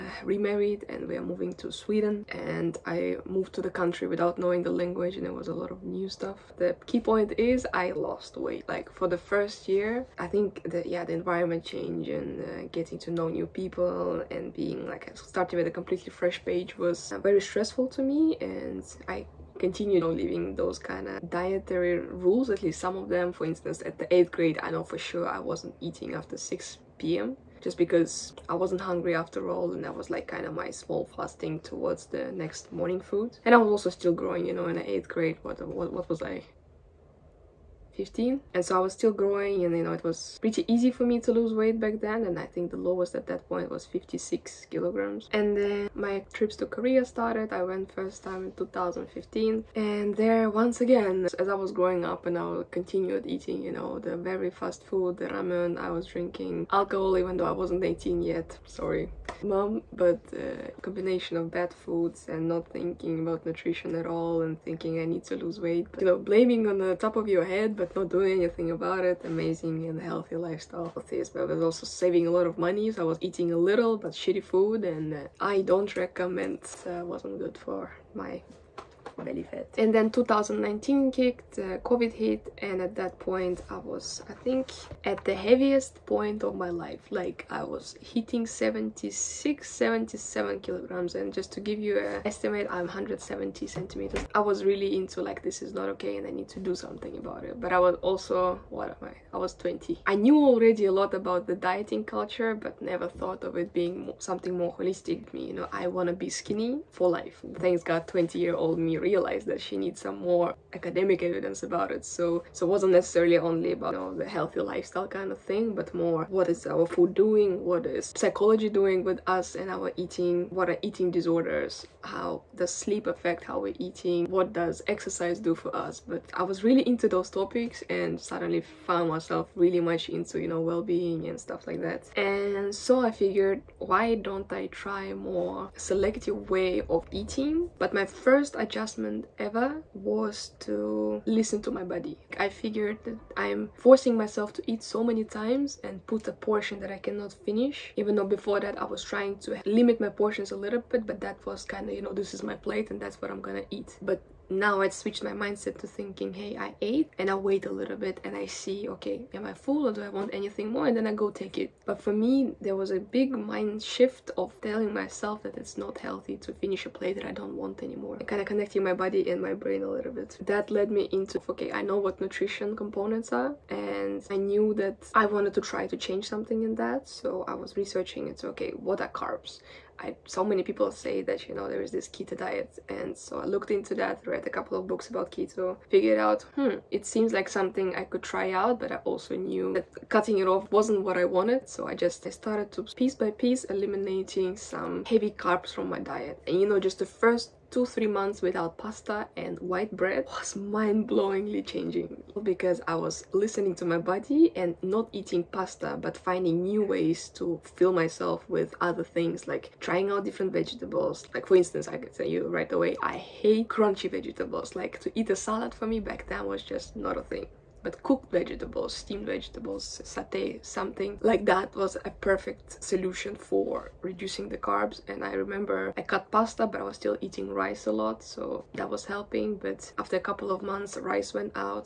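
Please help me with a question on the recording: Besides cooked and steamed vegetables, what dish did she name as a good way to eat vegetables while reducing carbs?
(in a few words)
satay.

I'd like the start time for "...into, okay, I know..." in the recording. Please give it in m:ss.
2:51.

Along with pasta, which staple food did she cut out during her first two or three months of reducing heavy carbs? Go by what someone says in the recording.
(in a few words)
white bread.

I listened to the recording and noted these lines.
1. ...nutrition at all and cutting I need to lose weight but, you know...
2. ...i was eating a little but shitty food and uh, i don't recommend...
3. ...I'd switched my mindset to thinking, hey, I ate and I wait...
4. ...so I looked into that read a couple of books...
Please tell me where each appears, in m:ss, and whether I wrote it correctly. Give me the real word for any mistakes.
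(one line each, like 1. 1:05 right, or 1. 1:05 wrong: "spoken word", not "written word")
1. 1:03 wrong: "thinking", not "cutting"
2. 1:13 right
3. 2:34 right
4. 3:03 right.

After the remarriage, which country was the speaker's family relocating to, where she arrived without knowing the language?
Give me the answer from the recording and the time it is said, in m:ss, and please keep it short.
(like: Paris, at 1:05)
Sweden, at 0:01.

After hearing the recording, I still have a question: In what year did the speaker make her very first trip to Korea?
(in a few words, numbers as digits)
2015.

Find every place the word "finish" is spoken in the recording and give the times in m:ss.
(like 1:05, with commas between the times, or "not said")
2:27, 2:46.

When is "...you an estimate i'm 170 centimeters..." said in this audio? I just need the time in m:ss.
1:31.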